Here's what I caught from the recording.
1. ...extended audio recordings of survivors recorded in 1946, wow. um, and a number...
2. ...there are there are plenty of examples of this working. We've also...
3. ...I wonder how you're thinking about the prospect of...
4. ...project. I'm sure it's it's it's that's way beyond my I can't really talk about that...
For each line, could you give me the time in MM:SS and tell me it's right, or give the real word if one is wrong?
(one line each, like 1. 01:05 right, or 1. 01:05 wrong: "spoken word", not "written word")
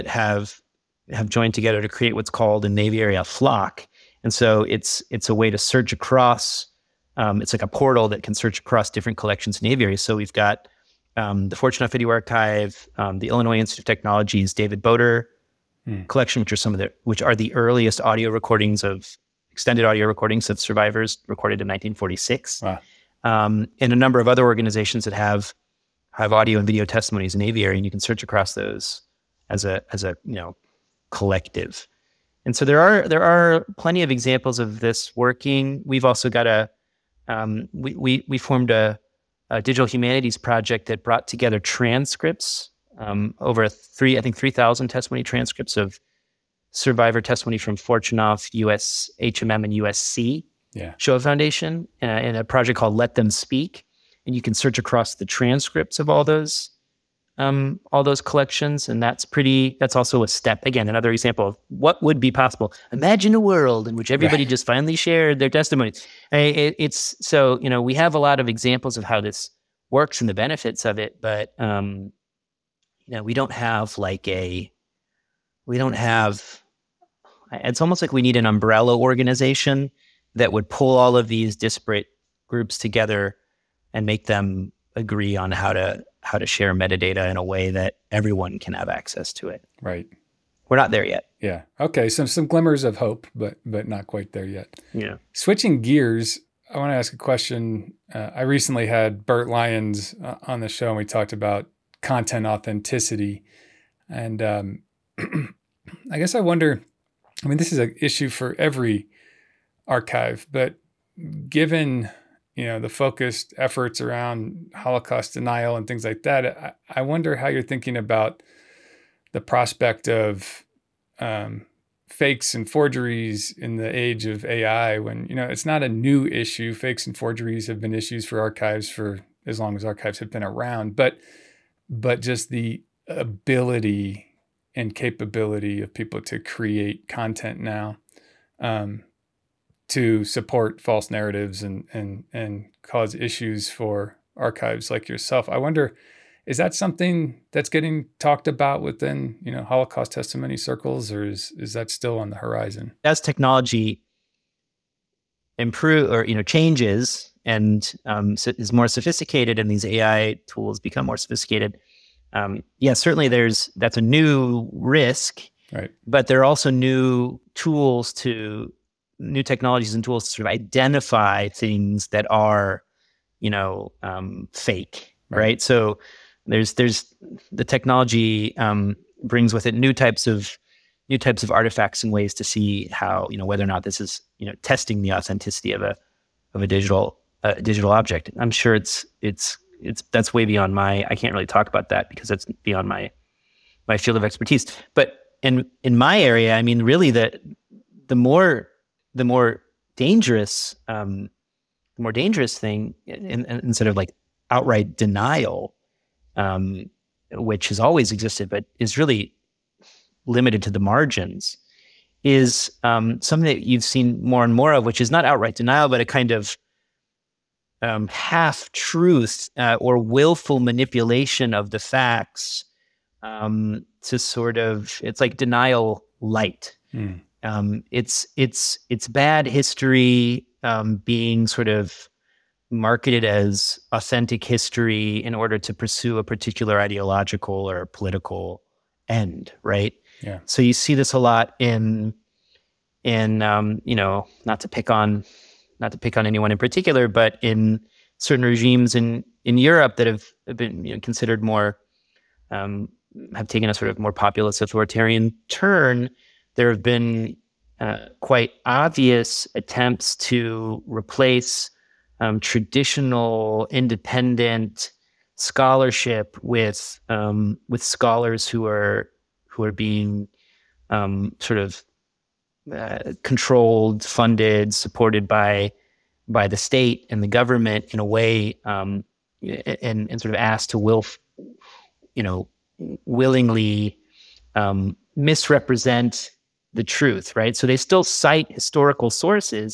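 1. 00:19 right
2. 00:32 right
3. 01:56 right
4. 03:07 wrong: "object", not "project".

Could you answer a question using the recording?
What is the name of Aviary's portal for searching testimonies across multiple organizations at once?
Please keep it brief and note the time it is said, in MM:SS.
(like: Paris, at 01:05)
flock, at 00:03.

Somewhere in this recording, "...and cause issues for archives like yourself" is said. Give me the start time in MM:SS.
02:22.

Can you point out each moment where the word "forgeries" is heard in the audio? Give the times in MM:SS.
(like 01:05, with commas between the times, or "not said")
02:02, 02:07.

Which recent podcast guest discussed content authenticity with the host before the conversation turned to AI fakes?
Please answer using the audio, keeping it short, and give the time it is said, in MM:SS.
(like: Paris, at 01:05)
Burt Lyons, at 01:39.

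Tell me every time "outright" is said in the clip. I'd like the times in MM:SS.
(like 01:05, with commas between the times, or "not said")
03:24, 03:35.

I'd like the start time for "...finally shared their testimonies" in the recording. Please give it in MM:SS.
01:04.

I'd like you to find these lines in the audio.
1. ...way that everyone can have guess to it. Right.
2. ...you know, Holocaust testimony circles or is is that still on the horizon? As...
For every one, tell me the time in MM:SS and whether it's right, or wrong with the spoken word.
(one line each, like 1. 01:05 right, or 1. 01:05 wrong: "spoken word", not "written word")
1. 01:27 wrong: "access", not "guess"
2. 02:29 right.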